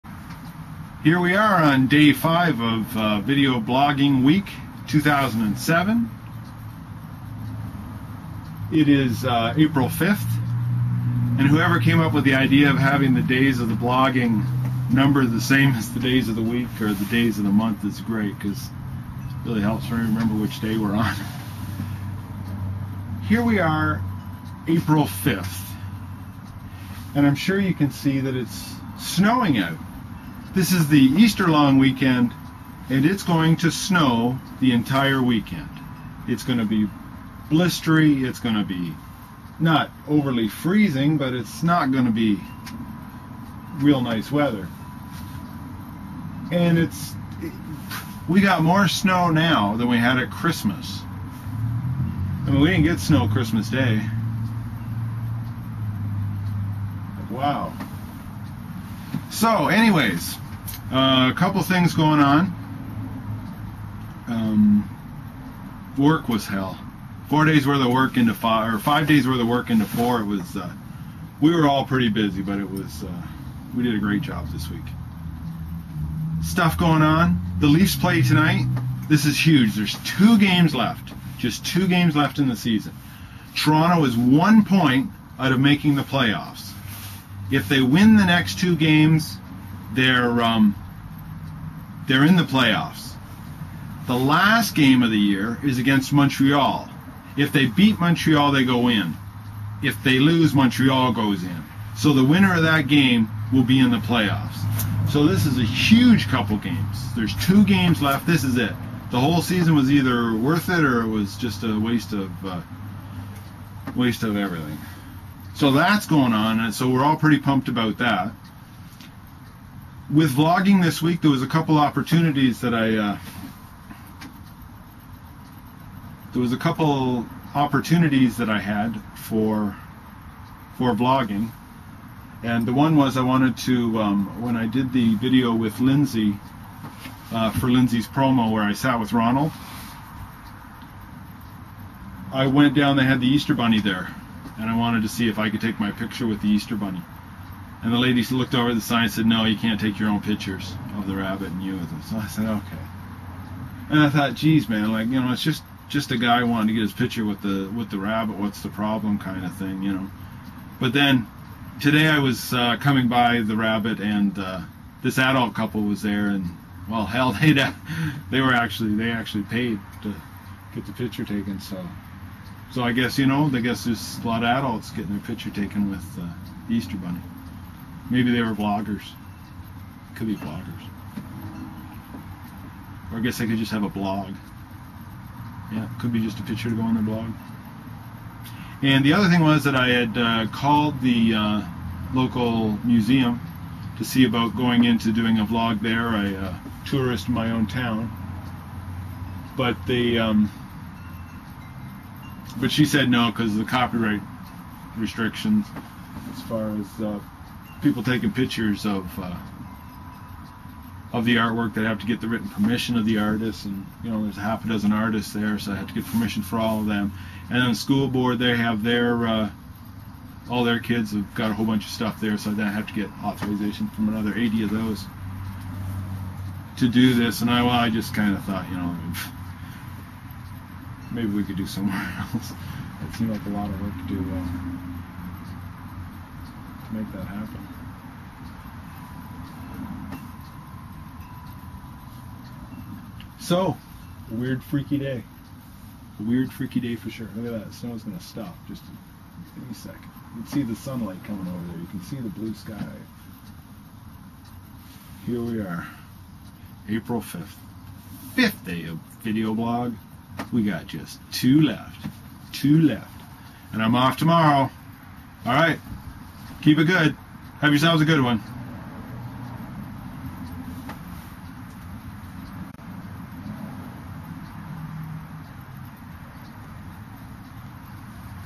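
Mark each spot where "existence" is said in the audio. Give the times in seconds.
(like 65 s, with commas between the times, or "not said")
not said.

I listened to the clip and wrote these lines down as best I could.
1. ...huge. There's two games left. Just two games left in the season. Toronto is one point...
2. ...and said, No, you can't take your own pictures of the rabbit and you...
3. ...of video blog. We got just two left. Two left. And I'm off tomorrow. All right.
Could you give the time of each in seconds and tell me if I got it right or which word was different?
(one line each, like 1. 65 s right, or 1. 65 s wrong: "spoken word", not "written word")
1. 79 s right
2. 149 s right
3. 258 s right.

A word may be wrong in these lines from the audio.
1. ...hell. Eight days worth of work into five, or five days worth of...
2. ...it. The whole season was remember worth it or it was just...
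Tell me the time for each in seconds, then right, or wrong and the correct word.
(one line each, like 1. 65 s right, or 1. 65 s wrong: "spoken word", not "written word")
1. 66 s wrong: "Four", not "Eight"
2. 108 s wrong: "either", not "remember".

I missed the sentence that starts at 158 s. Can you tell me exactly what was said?
What's the problem, kind of thing, you know.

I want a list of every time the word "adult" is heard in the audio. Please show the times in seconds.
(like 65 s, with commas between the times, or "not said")
165 s, 174 s.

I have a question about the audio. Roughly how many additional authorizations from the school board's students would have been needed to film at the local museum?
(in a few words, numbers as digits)
80.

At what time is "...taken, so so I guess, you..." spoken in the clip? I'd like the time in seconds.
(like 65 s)
171 s.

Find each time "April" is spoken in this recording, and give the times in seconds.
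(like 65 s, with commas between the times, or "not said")
9 s, 24 s, 256 s.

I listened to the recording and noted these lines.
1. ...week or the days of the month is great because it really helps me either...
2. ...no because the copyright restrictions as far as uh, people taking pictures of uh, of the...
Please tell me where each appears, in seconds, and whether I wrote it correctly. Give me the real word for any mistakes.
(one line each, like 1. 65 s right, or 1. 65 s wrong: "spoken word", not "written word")
1. 16 s wrong: "remember", not "either"
2. 203 s right.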